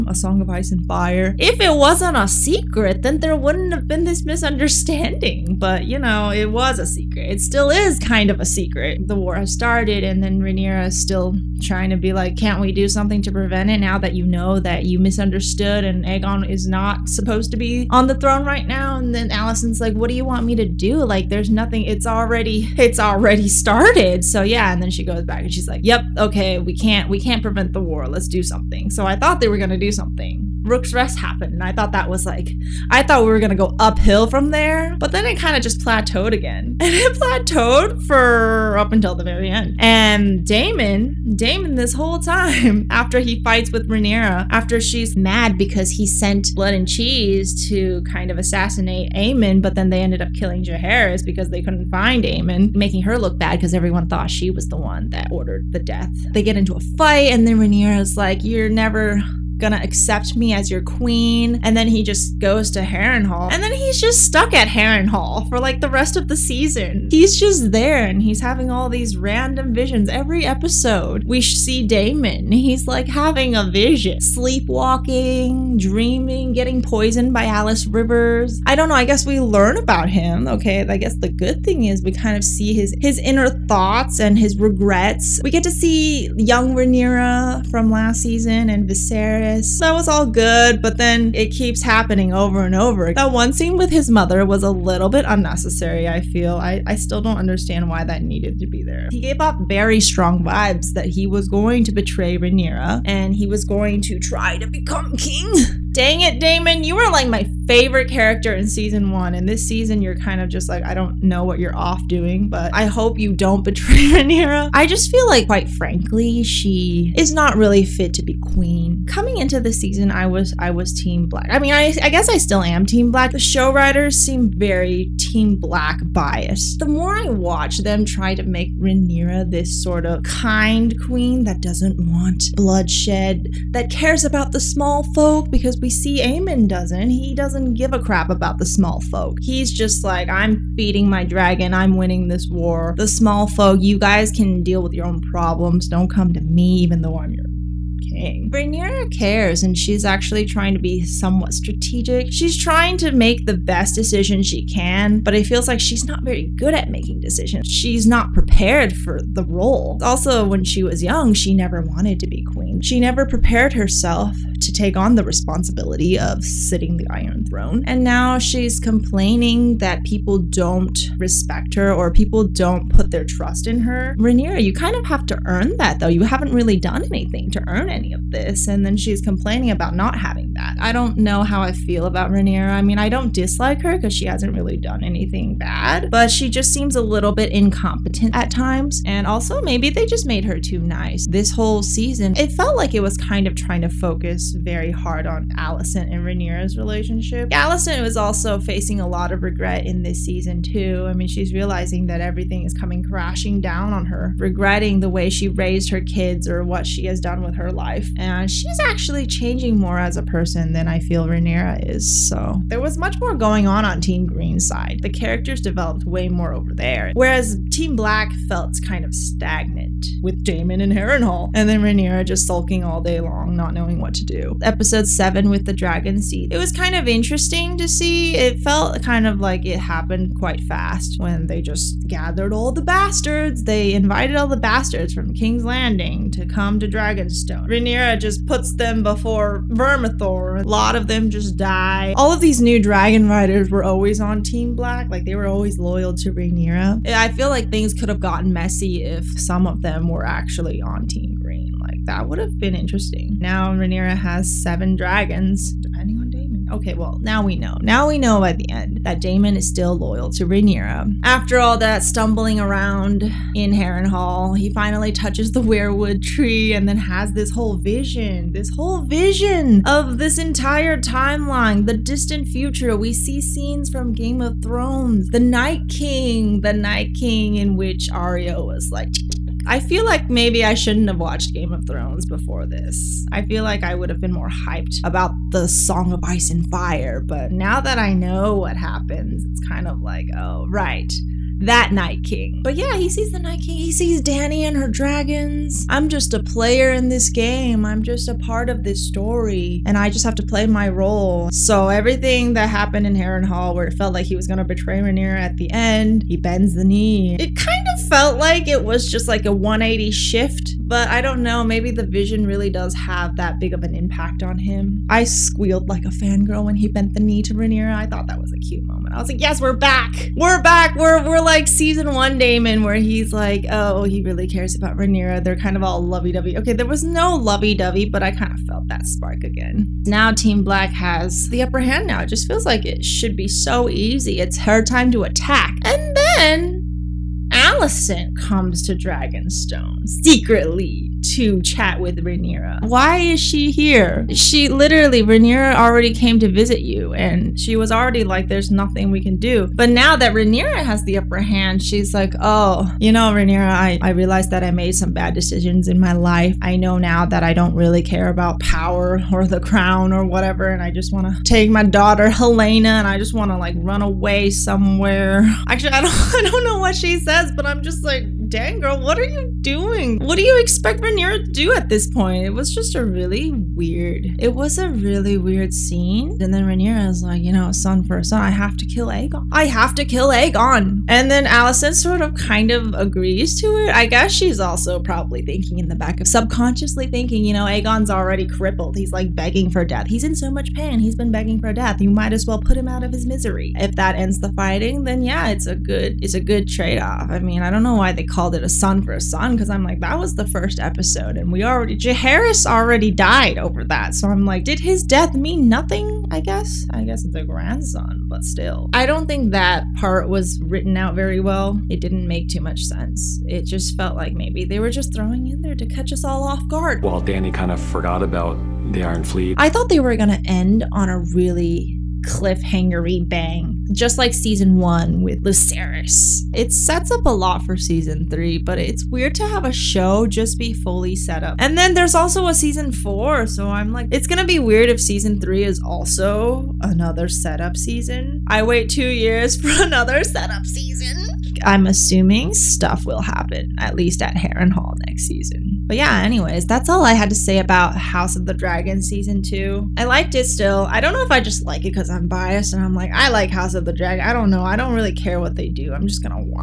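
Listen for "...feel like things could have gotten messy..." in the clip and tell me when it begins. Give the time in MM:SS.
04:07.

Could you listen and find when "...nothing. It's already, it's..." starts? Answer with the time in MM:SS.
00:21.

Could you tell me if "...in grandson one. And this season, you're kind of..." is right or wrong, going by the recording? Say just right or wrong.
wrong.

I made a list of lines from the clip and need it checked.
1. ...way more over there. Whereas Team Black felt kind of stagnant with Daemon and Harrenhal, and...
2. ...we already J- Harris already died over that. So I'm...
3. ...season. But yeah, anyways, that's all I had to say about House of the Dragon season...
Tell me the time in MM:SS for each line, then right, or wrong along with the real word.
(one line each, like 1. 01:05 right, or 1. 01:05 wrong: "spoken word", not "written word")
1. 03:36 right
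2. 06:41 right
3. 07:25 right.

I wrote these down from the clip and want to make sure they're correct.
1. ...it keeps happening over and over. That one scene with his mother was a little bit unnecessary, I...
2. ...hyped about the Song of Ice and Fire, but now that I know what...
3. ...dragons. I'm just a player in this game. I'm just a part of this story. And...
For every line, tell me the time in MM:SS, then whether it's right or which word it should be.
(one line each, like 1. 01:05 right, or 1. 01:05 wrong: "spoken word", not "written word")
1. 01:31 right
2. 04:44 right
3. 04:54 right.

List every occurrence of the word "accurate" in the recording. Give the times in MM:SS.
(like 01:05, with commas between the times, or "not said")
not said.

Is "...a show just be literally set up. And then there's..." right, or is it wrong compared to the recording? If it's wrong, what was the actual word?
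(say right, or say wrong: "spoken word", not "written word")
wrong: "fully", not "literally".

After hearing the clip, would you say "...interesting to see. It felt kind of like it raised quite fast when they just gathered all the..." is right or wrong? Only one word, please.
wrong.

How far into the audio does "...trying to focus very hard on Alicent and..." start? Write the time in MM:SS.
03:13.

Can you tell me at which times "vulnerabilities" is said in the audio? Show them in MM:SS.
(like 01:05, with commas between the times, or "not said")
not said.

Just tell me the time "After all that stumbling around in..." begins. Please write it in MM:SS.
04:21.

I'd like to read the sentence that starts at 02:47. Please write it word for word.
And now she's complaining that people don't respect her or people don't put their trust in her.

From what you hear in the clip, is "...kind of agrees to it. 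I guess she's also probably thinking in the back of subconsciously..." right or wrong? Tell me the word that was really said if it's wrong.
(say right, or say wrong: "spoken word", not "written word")
right.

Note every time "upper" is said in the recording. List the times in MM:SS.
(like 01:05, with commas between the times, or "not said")
05:31, 05:51.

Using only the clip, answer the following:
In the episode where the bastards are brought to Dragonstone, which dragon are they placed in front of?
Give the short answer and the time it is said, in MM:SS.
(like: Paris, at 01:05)
Vermithor, at 03:59.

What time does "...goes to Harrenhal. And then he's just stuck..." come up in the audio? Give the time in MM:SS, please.
01:02.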